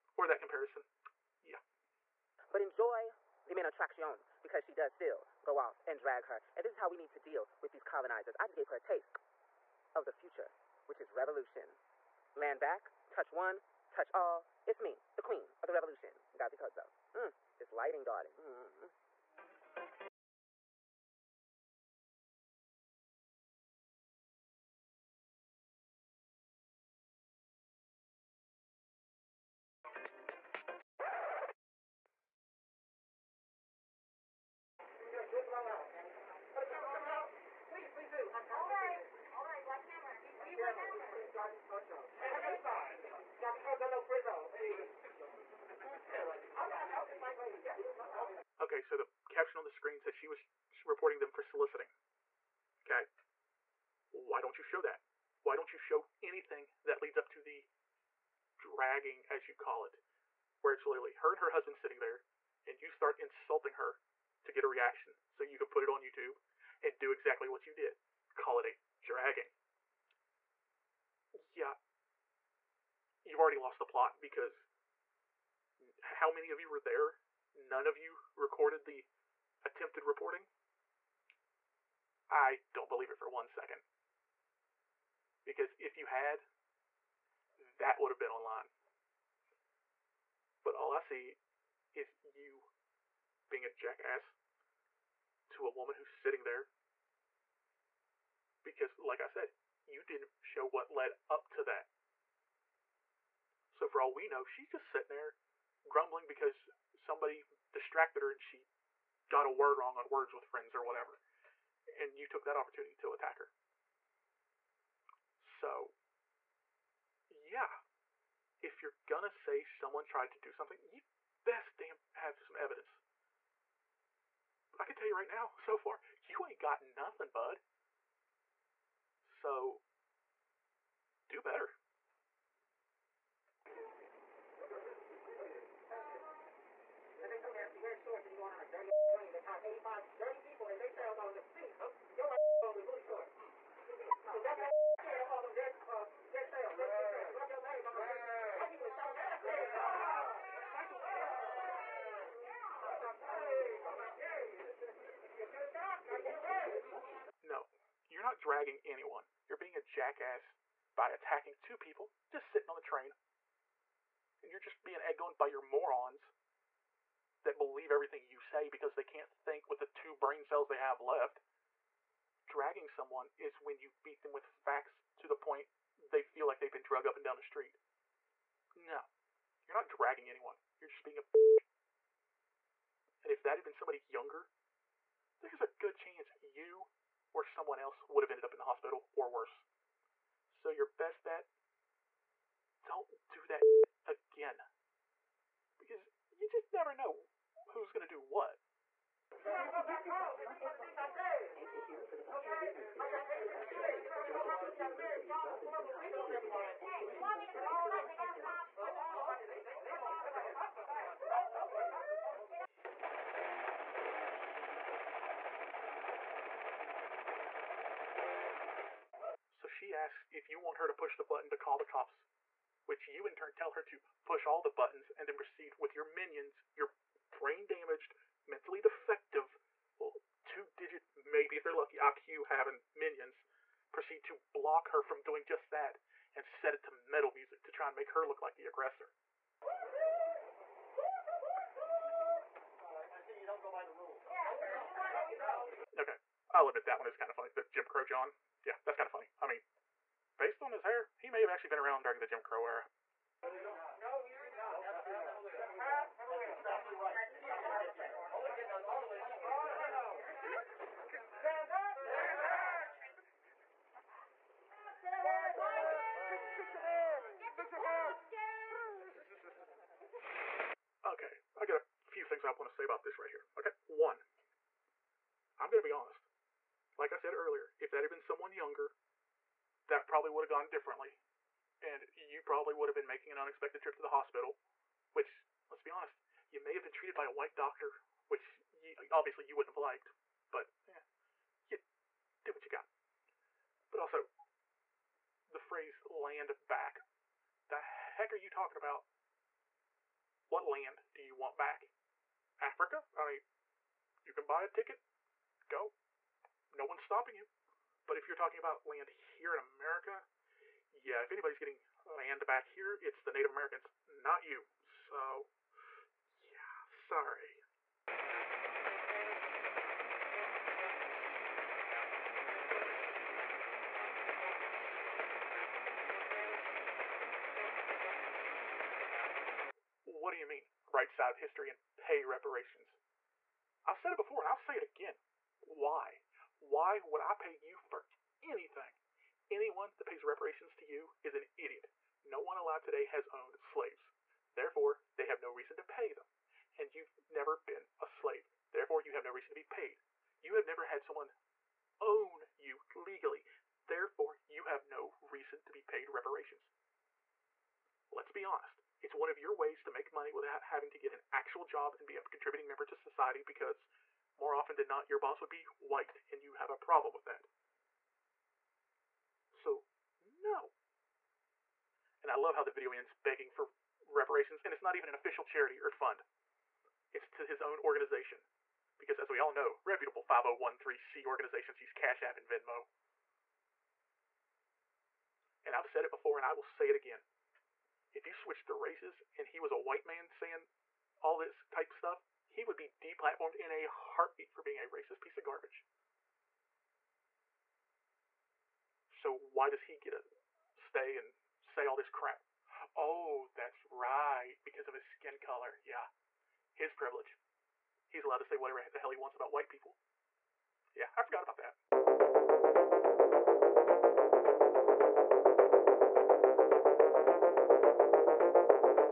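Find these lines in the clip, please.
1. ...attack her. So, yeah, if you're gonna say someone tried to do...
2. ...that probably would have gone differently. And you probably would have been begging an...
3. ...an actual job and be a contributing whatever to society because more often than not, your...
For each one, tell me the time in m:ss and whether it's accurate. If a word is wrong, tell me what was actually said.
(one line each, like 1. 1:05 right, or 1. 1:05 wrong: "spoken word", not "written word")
1. 1:53 right
2. 4:39 wrong: "making", not "begging"
3. 6:01 wrong: "member", not "whatever".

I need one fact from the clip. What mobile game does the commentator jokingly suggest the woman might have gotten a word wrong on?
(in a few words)
Words with Friends.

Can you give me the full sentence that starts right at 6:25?
And I've said it before and I will say it again.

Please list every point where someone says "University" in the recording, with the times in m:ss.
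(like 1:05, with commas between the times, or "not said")
3:23.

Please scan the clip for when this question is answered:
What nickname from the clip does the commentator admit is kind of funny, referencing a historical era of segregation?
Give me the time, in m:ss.
4:07.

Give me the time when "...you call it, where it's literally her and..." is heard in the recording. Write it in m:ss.
0:59.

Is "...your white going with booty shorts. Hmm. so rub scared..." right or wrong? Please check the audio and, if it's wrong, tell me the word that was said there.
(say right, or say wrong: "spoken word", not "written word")
right.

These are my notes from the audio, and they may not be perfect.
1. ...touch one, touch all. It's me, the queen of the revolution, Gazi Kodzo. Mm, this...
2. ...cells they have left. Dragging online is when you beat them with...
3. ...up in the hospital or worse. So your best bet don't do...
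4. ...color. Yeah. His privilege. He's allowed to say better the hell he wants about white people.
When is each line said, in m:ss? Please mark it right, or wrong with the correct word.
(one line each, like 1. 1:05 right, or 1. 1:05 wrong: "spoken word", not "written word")
1. 0:13 right
2. 2:50 wrong: "someone", not "online"
3. 3:08 right
4. 6:45 wrong: "whatever", not "better".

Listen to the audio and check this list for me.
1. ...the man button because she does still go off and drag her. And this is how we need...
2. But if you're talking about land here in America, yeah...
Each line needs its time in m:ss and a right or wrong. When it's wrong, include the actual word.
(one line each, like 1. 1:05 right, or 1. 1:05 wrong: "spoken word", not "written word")
1. 0:03 wrong: "attraction", not "button"
2. 5:08 right.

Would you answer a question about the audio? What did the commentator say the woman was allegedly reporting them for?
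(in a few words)
Soliciting.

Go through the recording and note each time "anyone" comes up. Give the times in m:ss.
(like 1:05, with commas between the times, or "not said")
2:38, 3:00, 5:39.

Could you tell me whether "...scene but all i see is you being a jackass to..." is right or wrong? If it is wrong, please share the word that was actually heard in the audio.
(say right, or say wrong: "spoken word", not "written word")
wrong: "online", not "scene".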